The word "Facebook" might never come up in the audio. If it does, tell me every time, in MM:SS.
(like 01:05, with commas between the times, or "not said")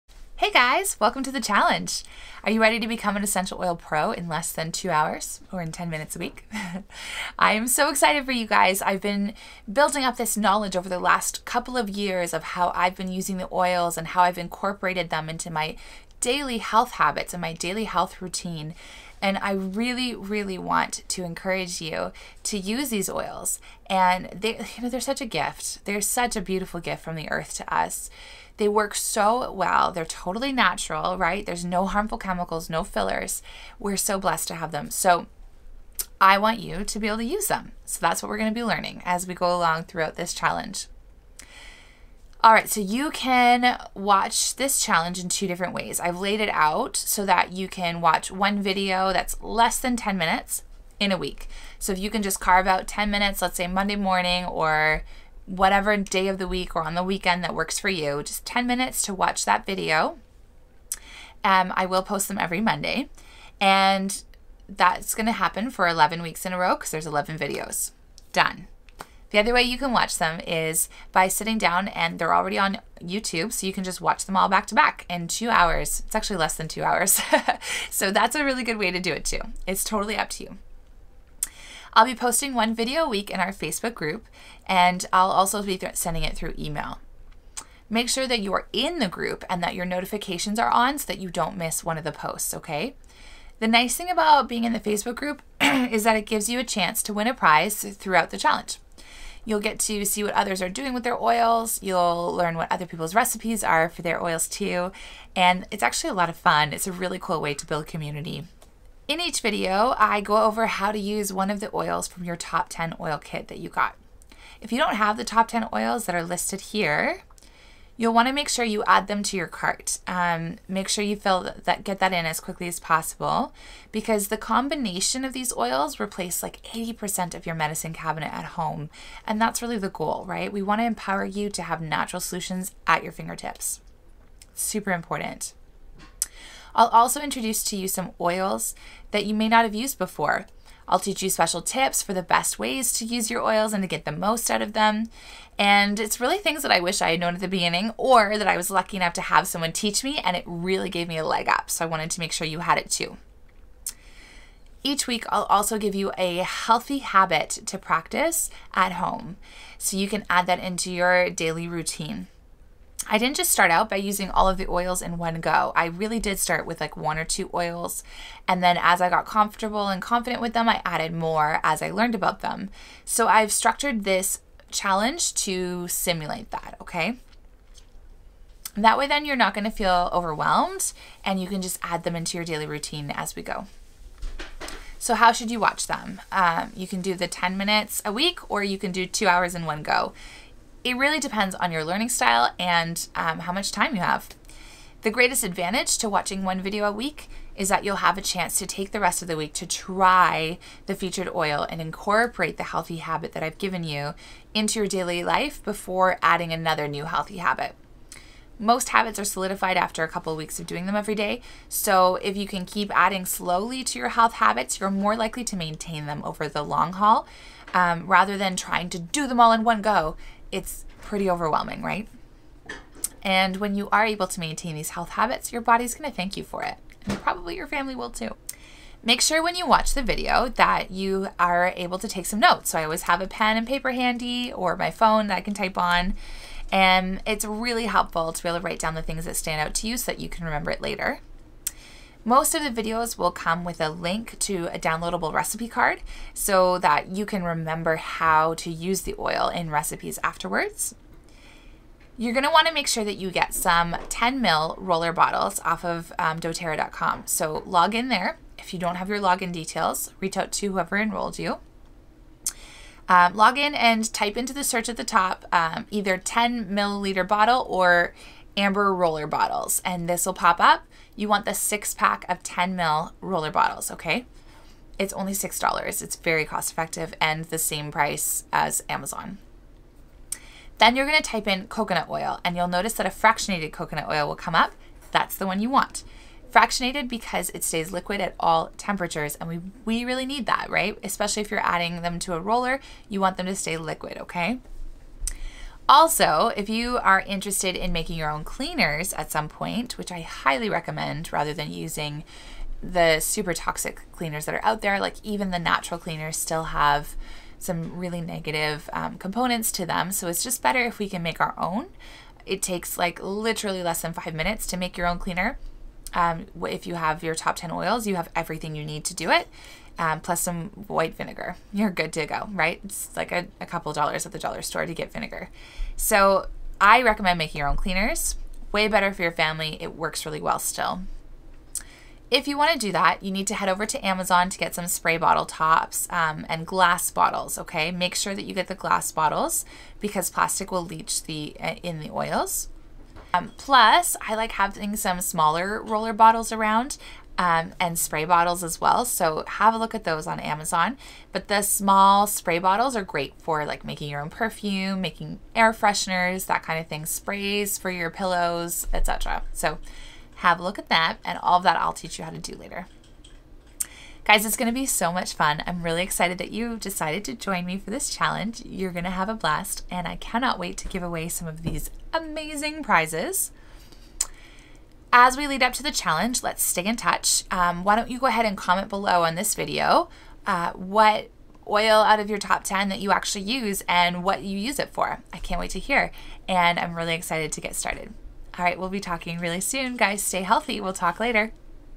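01:23, 01:34.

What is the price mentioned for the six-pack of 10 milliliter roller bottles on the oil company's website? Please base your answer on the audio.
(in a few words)
$6.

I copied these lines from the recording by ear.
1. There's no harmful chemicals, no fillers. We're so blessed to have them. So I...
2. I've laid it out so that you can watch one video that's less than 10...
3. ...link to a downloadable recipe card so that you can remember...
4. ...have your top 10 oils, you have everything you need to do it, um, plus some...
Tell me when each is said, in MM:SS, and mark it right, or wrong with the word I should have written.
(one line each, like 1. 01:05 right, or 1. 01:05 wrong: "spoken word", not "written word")
1. 00:31 right
2. 00:45 right
3. 04:03 right
4. 05:16 right.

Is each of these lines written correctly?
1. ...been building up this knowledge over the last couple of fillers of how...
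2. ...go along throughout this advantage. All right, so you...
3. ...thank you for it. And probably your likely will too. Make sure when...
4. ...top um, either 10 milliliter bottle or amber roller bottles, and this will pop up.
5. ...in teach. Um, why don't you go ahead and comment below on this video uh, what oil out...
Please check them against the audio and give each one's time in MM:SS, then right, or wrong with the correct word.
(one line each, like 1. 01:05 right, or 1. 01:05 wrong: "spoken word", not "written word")
1. 00:09 wrong: "years", not "fillers"
2. 00:39 wrong: "challenge", not "advantage"
3. 03:46 wrong: "family", not "likely"
4. 04:25 right
5. 06:16 wrong: "touch", not "teach".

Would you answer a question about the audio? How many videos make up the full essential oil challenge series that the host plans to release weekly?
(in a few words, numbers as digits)
11.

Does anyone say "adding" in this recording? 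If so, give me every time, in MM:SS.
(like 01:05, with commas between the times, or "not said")
03:26, 03:32, 04:51.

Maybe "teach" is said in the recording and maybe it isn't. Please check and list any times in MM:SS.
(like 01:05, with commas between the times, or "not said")
02:20, 02:29, 06:01.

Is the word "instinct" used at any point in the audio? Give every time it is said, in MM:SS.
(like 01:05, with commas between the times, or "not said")
not said.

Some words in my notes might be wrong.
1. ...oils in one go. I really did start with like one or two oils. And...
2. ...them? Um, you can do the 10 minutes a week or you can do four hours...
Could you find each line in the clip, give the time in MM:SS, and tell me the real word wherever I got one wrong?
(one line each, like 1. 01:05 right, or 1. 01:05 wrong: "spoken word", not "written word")
1. 02:44 right
2. 03:05 wrong: "two", not "four".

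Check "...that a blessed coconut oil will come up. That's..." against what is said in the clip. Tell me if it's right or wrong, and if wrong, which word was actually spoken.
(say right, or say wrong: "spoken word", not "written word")
wrong: "fractionated", not "blessed".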